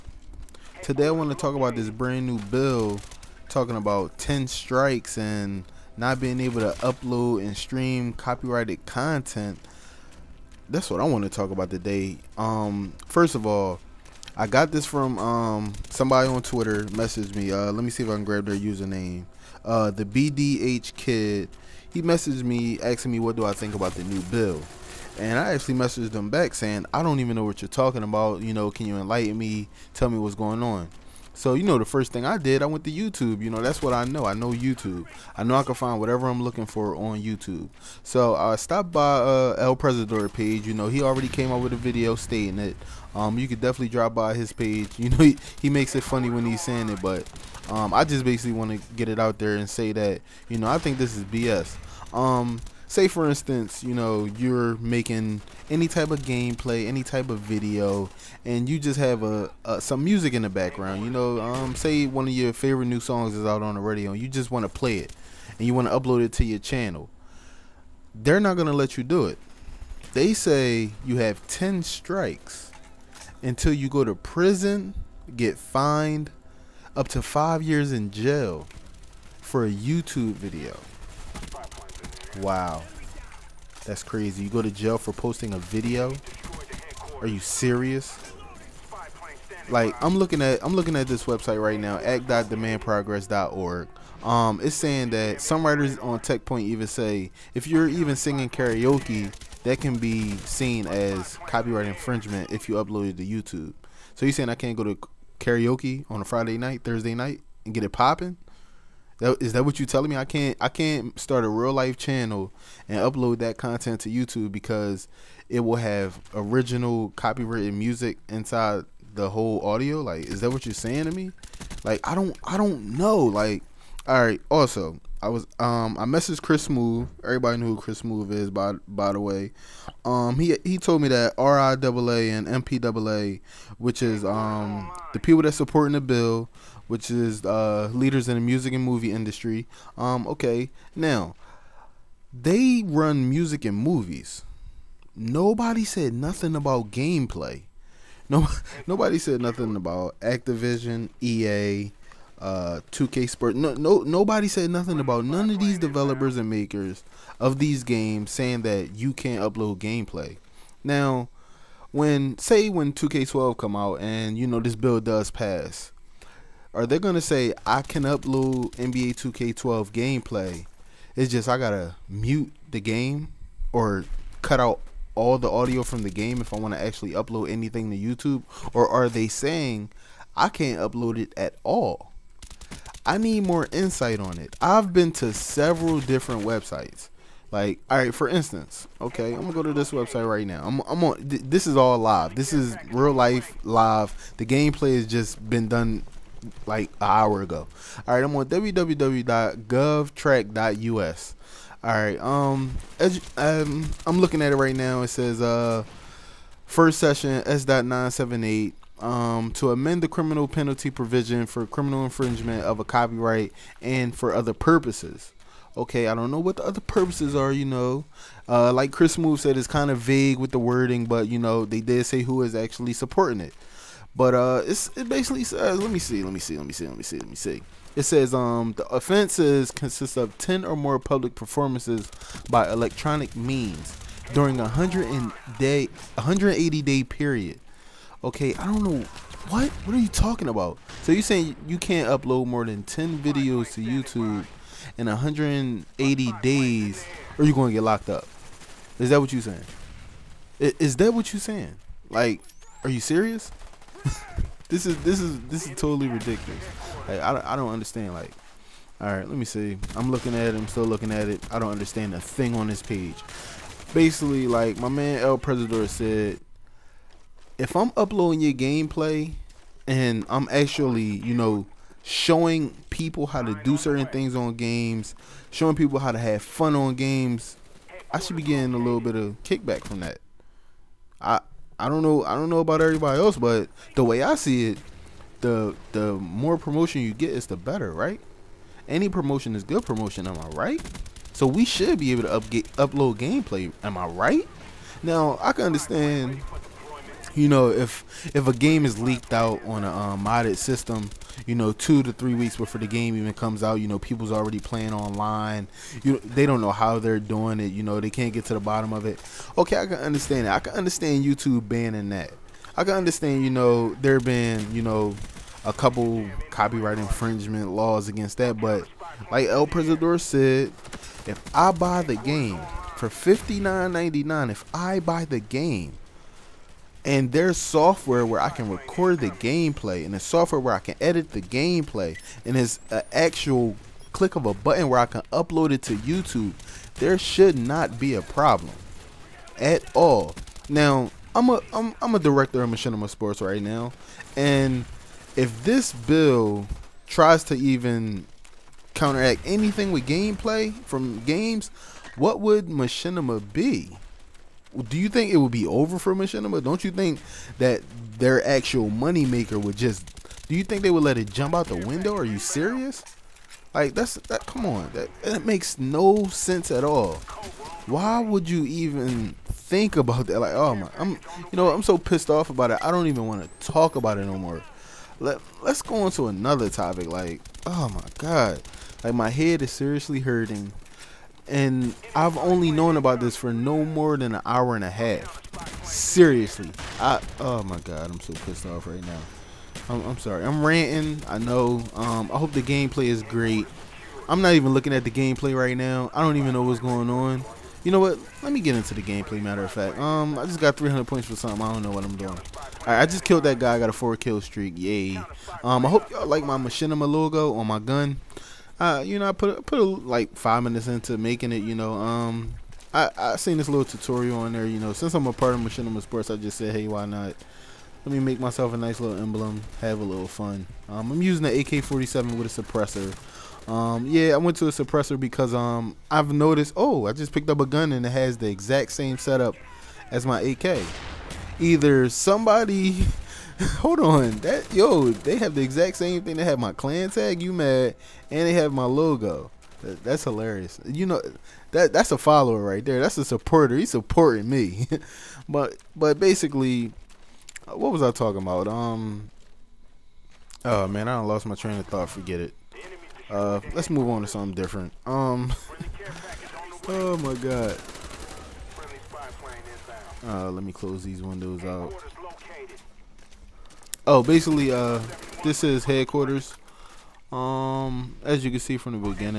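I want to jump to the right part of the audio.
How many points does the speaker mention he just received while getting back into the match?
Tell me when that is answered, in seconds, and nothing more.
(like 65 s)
400 s.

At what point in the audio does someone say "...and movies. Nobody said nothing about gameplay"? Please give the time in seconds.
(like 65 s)
143 s.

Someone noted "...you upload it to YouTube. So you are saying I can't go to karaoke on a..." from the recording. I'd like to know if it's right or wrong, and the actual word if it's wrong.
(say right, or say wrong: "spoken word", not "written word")
right.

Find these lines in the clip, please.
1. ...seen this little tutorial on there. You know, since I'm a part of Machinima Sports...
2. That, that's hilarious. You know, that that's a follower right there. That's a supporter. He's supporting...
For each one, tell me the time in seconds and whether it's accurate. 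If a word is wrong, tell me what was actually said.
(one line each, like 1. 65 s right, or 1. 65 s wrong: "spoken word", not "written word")
1. 413 s right
2. 439 s right.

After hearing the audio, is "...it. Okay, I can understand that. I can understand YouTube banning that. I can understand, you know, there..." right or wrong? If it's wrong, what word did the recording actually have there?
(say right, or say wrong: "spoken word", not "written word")
right.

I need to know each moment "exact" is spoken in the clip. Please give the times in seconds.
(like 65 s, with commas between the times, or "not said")
428 s, 435 s.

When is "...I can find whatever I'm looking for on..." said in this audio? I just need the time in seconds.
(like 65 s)
35 s.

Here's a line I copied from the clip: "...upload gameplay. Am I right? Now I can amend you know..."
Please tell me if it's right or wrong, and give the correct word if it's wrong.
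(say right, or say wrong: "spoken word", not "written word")
wrong: "understand", not "amend".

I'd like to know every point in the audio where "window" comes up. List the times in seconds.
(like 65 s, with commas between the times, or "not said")
361 s, 461 s.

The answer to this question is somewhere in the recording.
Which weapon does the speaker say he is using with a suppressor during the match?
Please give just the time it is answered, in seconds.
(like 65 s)
421 s.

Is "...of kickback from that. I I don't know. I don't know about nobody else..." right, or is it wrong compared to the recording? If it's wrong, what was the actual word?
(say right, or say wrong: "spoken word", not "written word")
wrong: "everybody", not "nobody".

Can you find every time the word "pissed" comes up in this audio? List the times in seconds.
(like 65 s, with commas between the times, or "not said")
371 s, 388 s.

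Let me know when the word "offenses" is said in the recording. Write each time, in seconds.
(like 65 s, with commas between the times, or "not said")
228 s.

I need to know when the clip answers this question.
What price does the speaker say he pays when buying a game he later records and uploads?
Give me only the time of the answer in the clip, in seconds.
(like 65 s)
323 s.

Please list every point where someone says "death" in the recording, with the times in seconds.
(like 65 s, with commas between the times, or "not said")
not said.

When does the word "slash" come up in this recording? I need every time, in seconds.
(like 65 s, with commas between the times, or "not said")
not said.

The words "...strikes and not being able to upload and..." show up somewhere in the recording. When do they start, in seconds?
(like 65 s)
4 s.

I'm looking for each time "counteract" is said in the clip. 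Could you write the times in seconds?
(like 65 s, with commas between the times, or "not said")
348 s.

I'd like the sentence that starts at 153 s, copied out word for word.
No, no, nobody said nothing about none of these developers and makers of these games saying that you can't upload gameplay.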